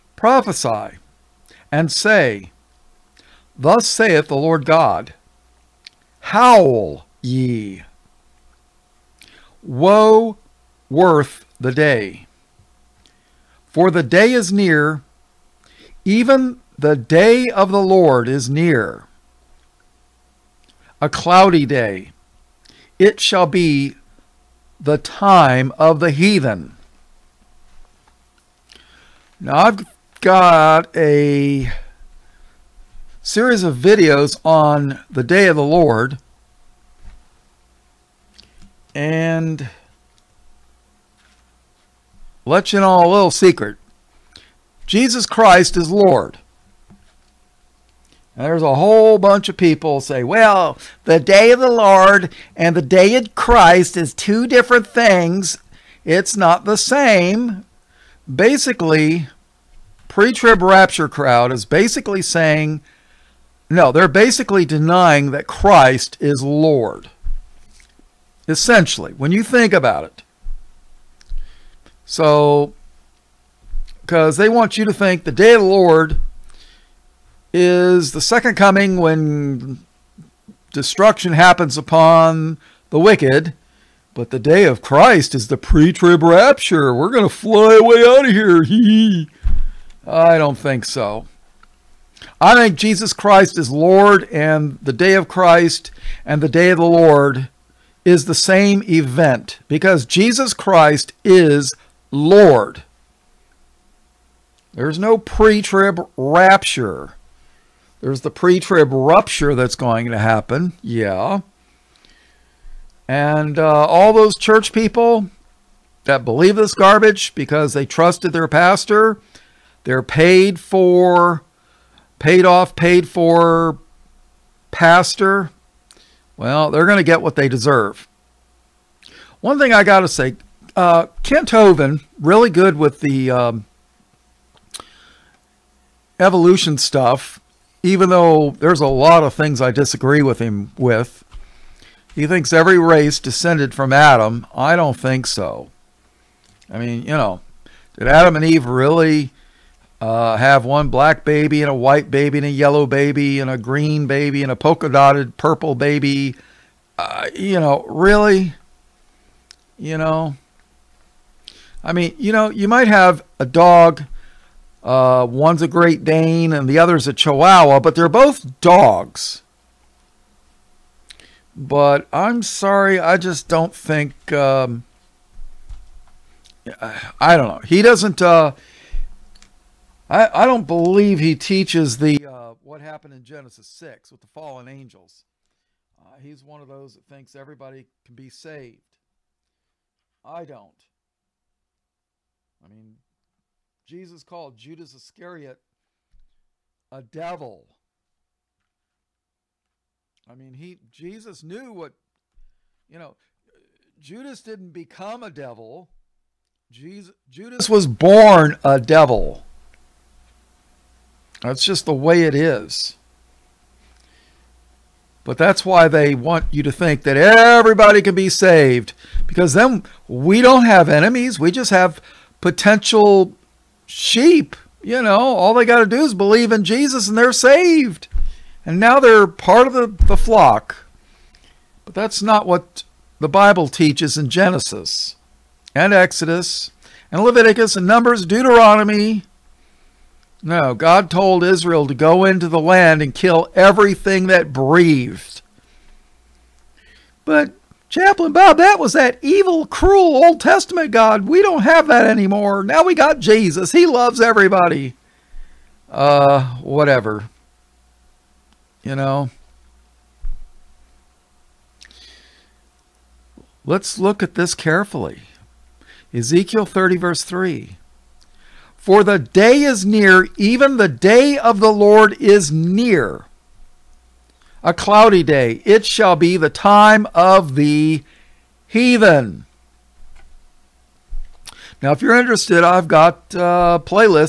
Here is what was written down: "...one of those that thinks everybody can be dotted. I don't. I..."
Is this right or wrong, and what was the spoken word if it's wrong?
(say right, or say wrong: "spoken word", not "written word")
wrong: "saved", not "dotted".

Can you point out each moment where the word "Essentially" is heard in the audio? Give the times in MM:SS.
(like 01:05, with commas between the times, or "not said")
01:08.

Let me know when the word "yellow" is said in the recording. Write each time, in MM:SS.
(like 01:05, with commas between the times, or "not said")
02:32.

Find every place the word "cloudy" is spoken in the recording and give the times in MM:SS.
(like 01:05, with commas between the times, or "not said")
00:21, 04:34.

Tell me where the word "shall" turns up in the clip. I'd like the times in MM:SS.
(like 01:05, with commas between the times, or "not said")
00:23, 04:35.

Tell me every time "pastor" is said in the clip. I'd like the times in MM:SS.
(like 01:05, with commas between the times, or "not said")
01:58, 02:04.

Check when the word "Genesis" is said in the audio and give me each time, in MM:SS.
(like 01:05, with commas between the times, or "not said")
03:03, 03:54.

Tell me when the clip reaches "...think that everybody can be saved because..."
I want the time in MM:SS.
03:36.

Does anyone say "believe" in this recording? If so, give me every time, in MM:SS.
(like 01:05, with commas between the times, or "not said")
01:56, 03:00, 03:46.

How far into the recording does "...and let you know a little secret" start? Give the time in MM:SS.
00:38.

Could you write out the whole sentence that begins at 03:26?
Jesus, Judas was born a devil.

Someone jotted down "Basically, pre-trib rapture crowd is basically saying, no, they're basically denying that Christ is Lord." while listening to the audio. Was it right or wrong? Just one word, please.
right.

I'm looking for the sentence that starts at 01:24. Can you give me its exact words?
But the day of Christ is the pre-trib rapture.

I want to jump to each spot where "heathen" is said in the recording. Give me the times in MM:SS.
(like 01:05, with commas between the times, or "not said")
00:26, 04:38.